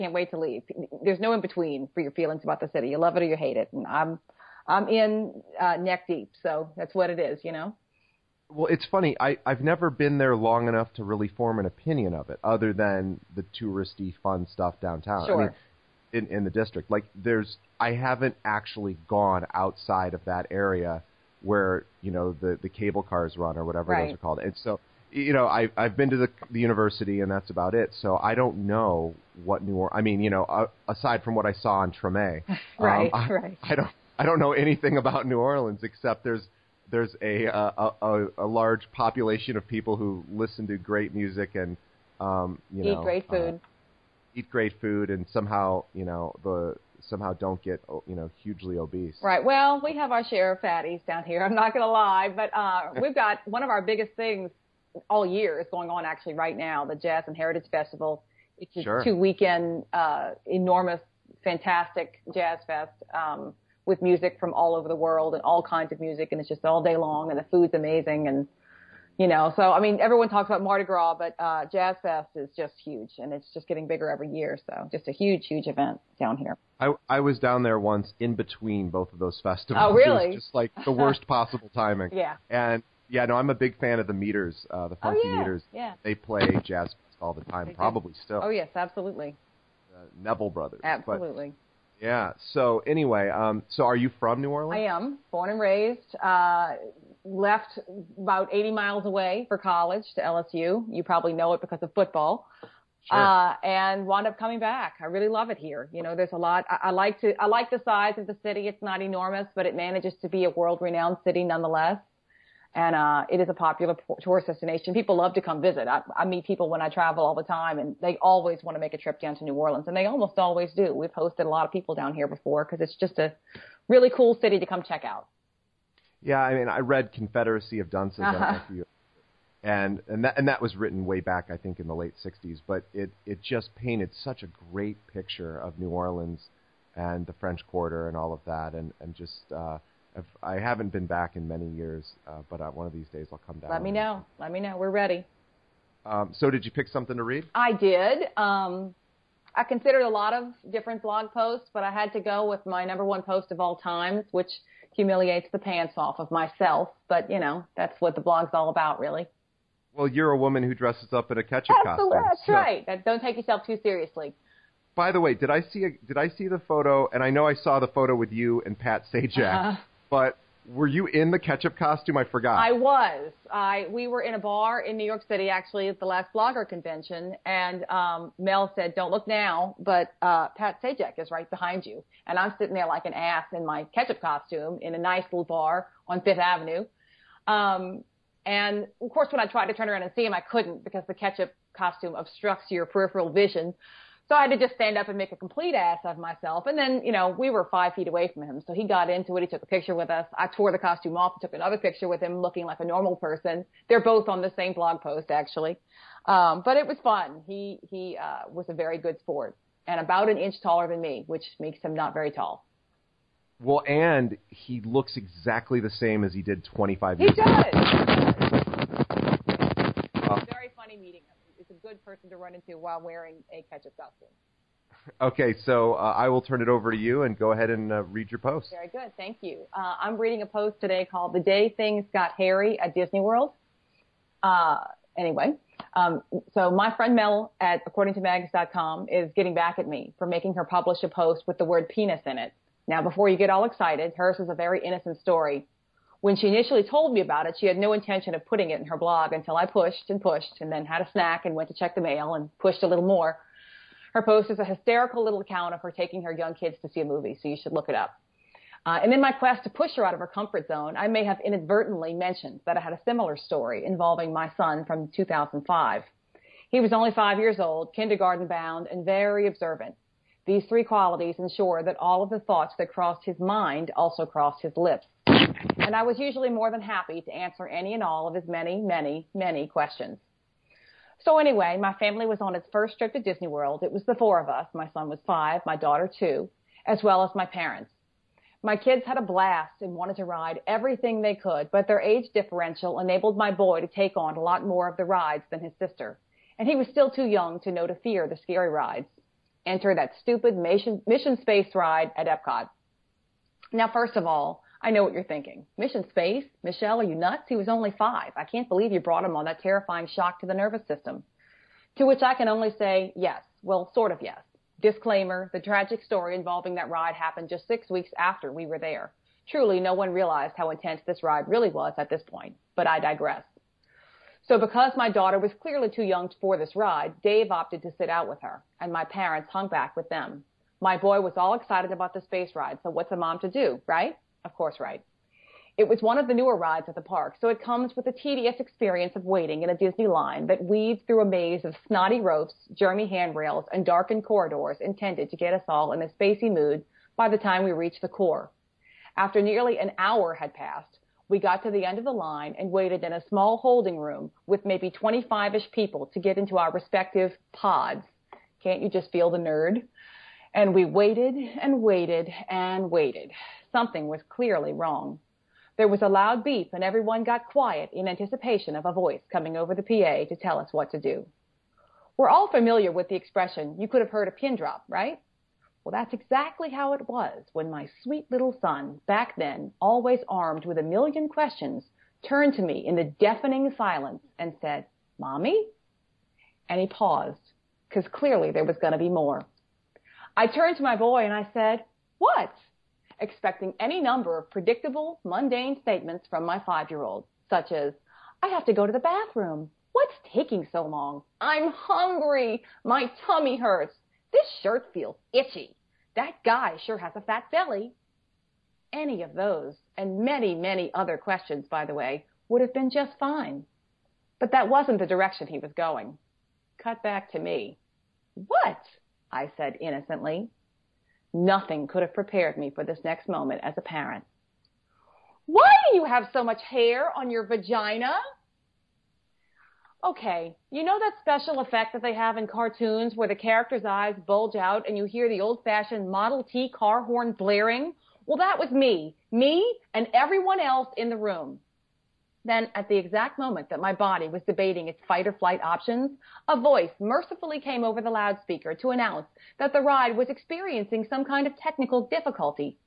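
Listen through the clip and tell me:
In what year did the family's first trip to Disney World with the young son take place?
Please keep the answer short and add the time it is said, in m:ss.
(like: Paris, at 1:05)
2005, at 4:25.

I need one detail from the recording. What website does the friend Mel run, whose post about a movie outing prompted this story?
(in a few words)
AccordingToMags.com.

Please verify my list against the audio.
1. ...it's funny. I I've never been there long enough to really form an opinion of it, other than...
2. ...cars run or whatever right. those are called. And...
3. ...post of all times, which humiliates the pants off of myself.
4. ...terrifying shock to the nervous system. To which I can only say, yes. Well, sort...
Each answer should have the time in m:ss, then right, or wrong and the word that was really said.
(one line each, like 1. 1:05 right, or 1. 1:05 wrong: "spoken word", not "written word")
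1. 0:08 right
2. 0:23 right
3. 2:33 right
4. 5:09 right.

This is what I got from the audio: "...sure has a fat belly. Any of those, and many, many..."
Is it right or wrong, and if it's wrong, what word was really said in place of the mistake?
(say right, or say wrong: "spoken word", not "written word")
right.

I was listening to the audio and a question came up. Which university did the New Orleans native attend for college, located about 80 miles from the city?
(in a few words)
LSU.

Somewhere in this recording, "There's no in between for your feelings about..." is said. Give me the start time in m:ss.
0:01.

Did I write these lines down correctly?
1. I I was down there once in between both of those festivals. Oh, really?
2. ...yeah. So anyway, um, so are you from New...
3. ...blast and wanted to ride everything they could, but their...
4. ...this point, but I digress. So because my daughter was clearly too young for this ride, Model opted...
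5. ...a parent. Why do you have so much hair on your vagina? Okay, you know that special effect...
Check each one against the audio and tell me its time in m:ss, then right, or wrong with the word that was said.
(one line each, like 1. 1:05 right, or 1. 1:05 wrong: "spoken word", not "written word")
1. 1:16 right
2. 1:32 right
3. 4:49 right
4. 5:22 wrong: "Dave", not "Model"
5. 7:03 right.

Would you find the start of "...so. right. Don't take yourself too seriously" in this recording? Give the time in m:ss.
2:42.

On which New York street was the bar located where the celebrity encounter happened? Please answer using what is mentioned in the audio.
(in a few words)
Fifth Avenue.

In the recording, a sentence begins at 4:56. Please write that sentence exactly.
And he was still too young to know to fear the scary rides.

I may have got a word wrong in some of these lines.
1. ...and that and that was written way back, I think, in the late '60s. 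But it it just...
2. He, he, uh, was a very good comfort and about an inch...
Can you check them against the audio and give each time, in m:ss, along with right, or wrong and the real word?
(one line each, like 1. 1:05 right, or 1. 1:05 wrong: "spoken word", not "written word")
1. 2:10 right
2. 3:27 wrong: "sport", not "comfort".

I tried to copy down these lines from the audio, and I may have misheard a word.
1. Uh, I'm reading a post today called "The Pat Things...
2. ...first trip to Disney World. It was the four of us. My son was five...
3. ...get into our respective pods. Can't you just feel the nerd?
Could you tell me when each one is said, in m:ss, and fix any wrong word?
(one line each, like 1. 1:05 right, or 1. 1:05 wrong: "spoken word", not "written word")
1. 3:49 wrong: "Day", not "Pat"
2. 4:42 right
3. 5:56 right.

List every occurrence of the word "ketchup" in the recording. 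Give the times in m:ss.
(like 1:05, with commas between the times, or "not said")
2:41, 2:51, 3:03, 3:11, 3:43.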